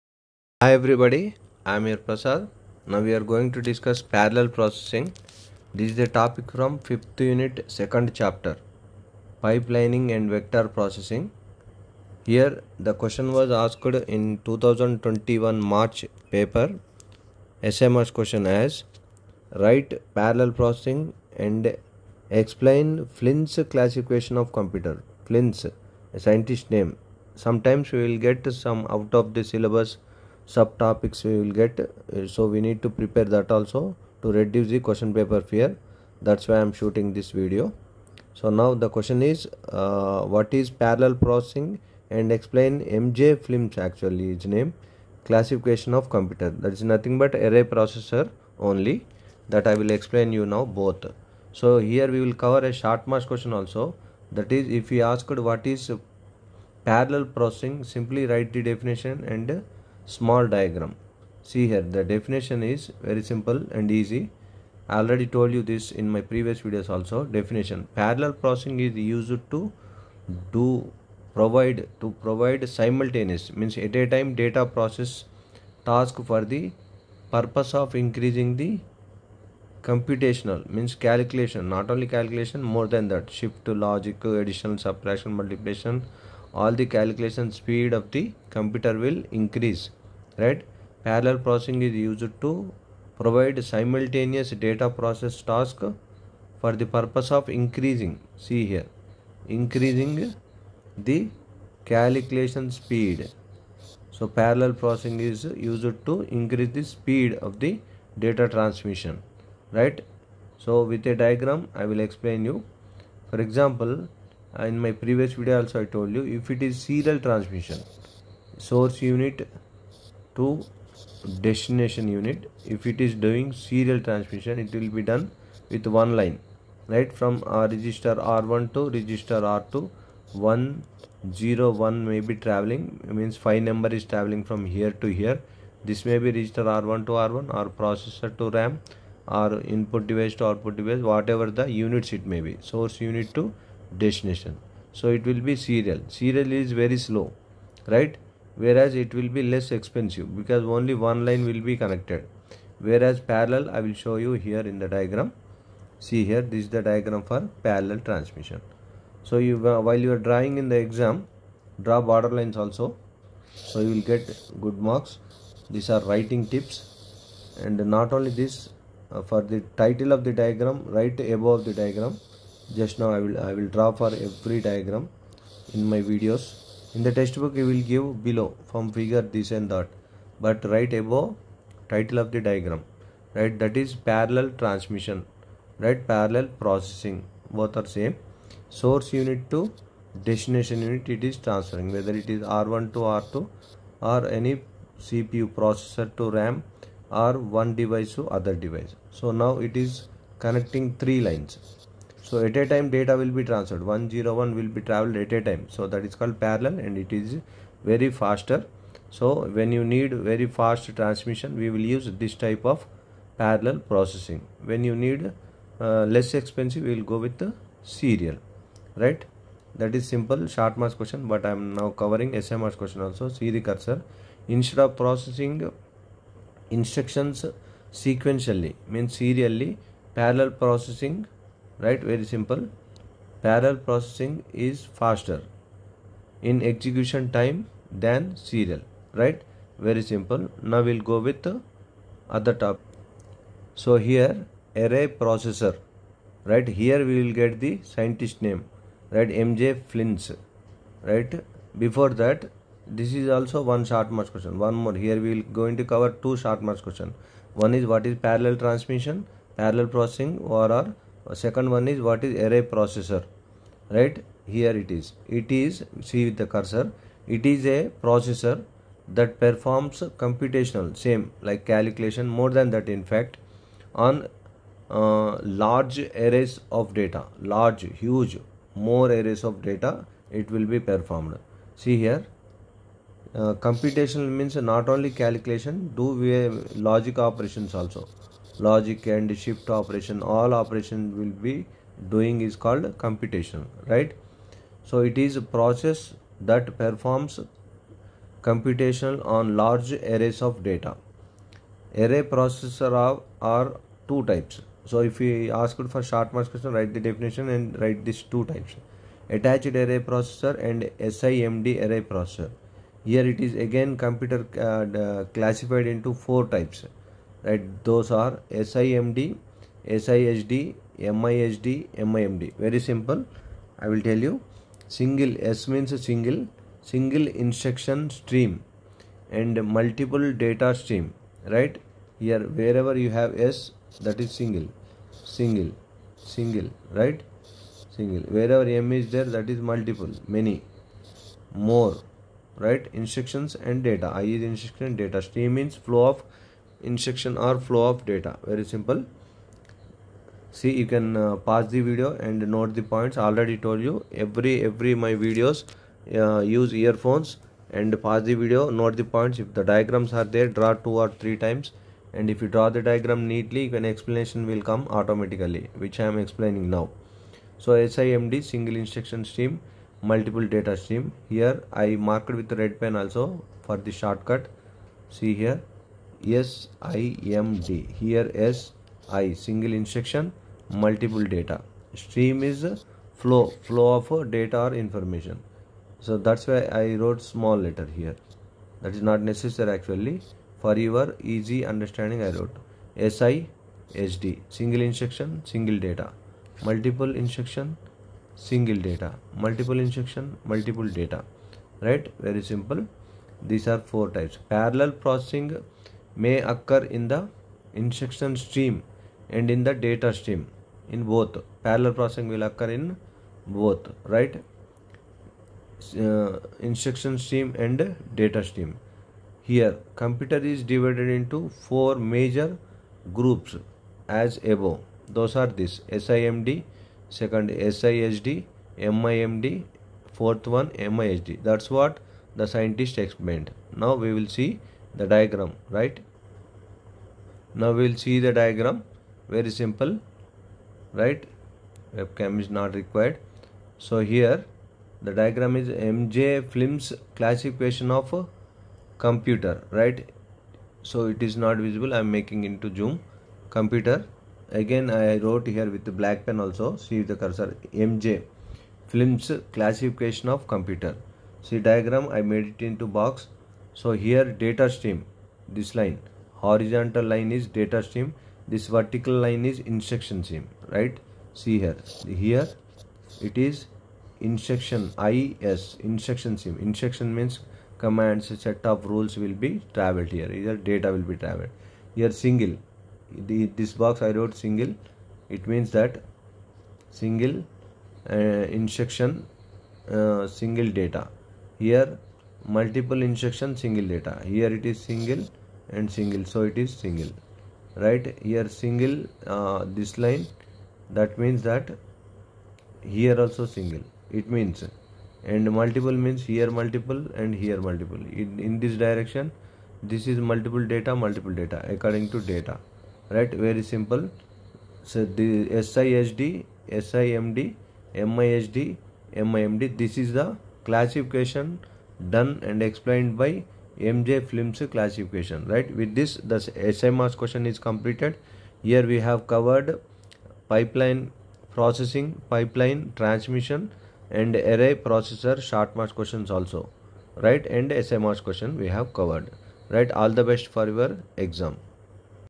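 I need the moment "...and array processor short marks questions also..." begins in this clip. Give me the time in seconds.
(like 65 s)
534 s.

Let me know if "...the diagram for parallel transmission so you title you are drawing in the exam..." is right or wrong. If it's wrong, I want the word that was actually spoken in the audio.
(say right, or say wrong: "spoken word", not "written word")
wrong: "while", not "title".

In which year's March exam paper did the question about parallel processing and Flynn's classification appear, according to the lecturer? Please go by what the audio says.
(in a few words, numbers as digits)
2021.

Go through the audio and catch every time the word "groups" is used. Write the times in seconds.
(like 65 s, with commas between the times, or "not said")
423 s.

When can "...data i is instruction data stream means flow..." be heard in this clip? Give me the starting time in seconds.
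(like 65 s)
343 s.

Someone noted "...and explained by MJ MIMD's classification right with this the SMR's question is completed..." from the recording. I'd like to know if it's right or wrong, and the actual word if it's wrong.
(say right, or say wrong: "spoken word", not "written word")
wrong: "Flynn", not "MIMD".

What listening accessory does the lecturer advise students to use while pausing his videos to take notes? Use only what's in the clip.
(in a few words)
earphones.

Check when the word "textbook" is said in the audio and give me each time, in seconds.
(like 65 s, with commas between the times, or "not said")
177 s.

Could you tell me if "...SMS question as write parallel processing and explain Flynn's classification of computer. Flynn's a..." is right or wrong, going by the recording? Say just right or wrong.
right.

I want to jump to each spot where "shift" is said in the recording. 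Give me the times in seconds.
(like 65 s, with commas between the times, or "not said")
83 s, 289 s.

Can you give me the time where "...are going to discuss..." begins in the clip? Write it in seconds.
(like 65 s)
3 s.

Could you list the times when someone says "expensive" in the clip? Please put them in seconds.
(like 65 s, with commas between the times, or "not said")
149 s, 216 s.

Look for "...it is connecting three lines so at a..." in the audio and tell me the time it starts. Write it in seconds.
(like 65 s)
199 s.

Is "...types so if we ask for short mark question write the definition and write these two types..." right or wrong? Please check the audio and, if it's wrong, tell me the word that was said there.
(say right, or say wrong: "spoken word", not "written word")
right.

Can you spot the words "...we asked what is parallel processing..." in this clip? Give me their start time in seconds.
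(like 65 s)
54 s.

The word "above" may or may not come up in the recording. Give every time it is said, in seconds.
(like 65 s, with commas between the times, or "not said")
171 s, 180 s, 424 s.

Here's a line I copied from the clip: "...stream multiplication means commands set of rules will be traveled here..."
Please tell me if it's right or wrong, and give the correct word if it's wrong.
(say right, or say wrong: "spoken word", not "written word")
wrong: "instruction", not "multiplication".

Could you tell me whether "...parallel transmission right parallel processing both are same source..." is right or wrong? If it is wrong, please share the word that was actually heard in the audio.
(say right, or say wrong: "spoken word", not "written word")
right.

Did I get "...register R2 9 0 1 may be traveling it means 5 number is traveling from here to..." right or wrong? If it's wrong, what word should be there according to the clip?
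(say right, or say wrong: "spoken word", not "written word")
wrong: "1", not "9".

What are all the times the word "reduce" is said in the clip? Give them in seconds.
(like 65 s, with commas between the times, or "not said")
34 s.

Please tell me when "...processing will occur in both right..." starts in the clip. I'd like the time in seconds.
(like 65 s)
411 s.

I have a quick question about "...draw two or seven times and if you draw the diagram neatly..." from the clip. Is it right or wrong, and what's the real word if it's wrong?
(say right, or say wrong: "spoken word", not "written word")
wrong: "three", not "seven".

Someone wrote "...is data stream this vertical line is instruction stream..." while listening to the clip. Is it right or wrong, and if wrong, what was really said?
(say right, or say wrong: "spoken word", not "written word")
right.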